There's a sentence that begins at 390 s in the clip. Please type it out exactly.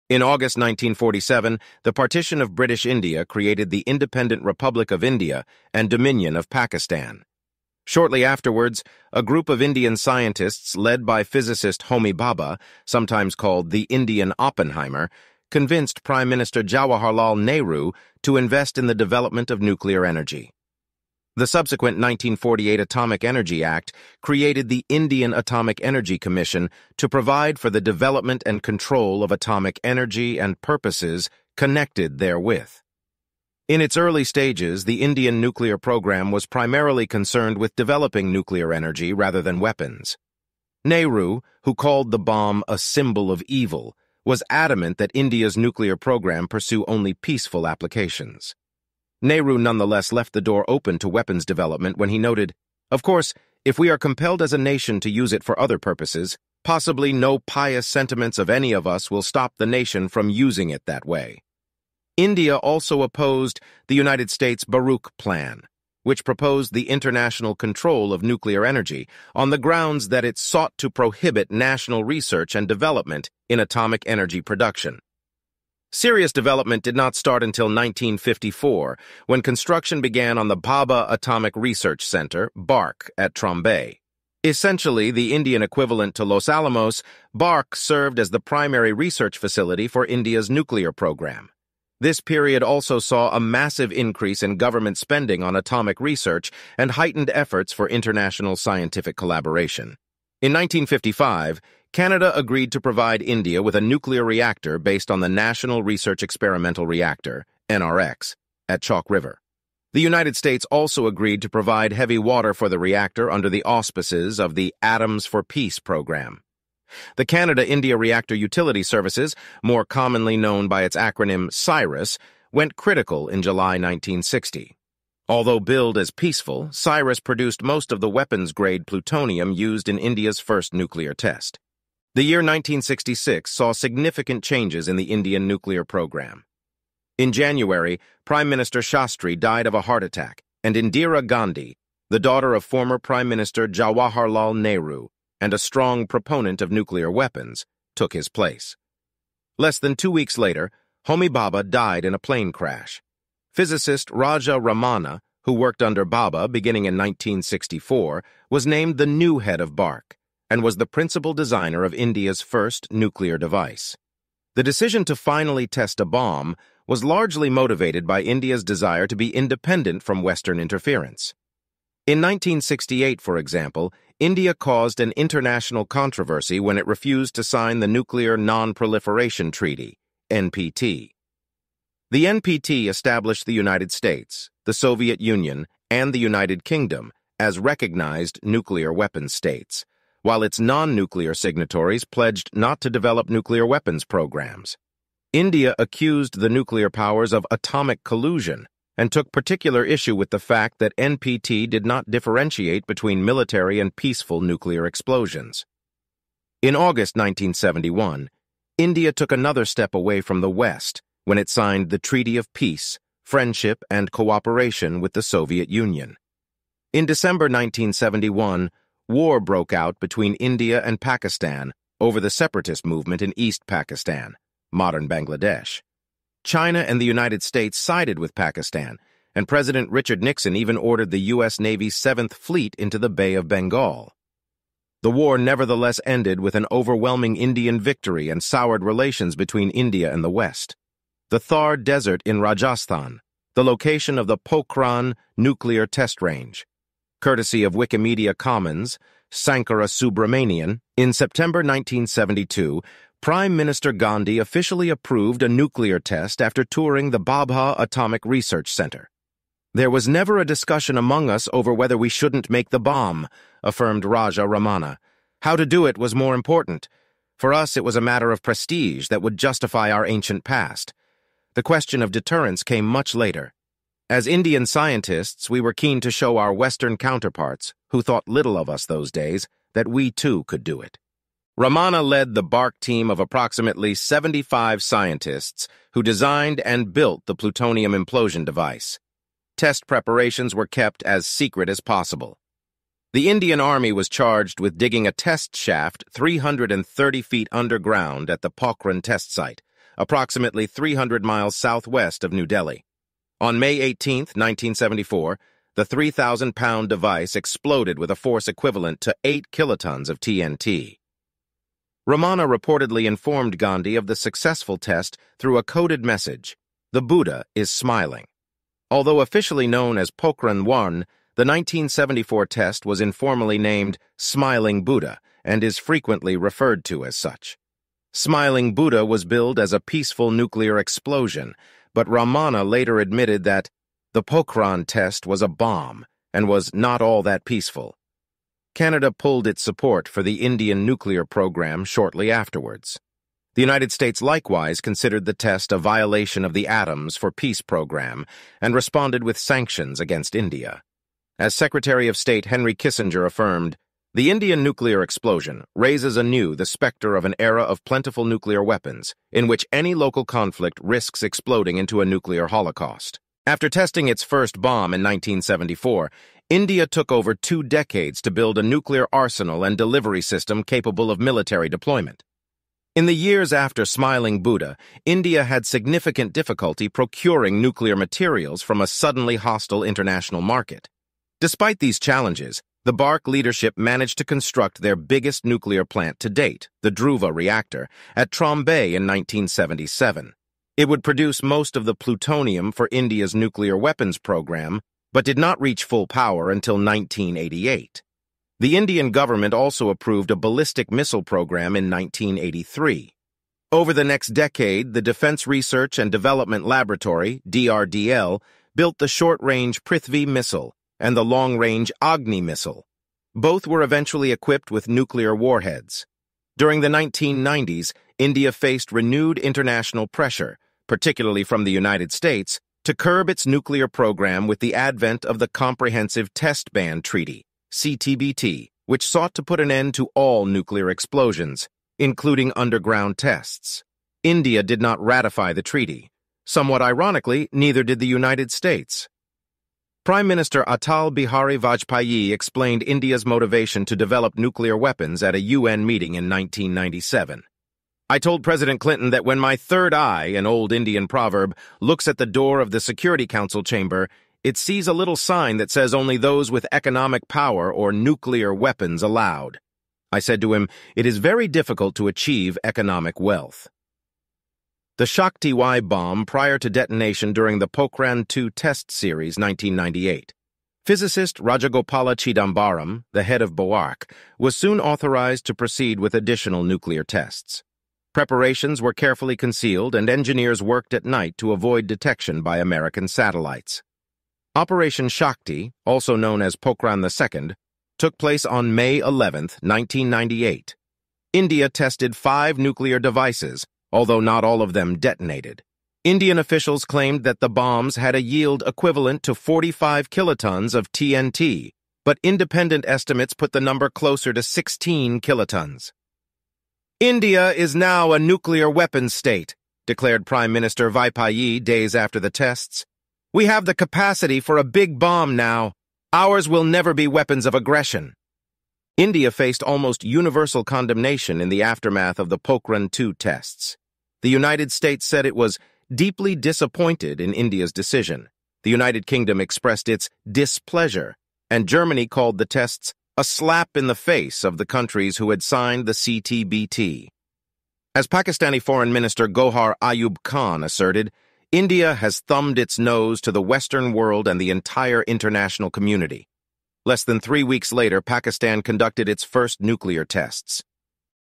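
It would produce most of the plutonium for India's nuclear weapons program, but did not reach full power until 1988.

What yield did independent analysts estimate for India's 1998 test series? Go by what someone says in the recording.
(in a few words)
16 kilotons.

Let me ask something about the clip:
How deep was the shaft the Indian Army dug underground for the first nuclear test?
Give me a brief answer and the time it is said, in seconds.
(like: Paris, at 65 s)
330 feet, at 296 s.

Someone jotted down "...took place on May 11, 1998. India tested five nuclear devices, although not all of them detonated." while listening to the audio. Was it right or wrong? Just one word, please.
right.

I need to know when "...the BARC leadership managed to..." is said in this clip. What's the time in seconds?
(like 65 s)
382 s.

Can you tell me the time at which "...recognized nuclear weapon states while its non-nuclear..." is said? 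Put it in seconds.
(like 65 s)
187 s.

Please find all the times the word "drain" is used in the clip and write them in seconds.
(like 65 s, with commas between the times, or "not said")
not said.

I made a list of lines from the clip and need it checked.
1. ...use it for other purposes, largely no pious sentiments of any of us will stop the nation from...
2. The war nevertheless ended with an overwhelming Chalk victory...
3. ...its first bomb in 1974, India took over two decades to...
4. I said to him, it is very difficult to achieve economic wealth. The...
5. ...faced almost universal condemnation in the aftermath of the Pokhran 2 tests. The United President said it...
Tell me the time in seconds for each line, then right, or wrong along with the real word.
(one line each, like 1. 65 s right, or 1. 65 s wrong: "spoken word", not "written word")
1. 55 s wrong: "possibly", not "largely"
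2. 235 s wrong: "Indian", not "Chalk"
3. 364 s right
4. 460 s right
5. 519 s wrong: "States", not "President".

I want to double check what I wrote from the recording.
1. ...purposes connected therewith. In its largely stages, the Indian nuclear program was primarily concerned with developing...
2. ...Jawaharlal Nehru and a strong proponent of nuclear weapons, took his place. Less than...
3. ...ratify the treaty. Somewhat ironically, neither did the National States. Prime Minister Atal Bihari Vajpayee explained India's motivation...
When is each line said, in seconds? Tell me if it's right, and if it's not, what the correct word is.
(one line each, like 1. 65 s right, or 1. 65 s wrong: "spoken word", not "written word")
1. 30 s wrong: "early", not "largely"
2. 143 s right
3. 435 s wrong: "United", not "National".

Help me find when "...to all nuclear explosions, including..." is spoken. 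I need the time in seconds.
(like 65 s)
429 s.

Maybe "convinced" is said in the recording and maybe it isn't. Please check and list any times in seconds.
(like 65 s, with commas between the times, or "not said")
15 s.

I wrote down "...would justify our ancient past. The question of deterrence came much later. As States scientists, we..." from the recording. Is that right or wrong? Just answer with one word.
wrong.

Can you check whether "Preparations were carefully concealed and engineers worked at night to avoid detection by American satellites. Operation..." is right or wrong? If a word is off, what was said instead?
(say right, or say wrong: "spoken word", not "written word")
right.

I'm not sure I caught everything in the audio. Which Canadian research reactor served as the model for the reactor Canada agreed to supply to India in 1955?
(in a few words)
National Research Experimental Reactor.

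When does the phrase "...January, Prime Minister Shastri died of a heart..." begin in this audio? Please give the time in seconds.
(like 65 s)
137 s.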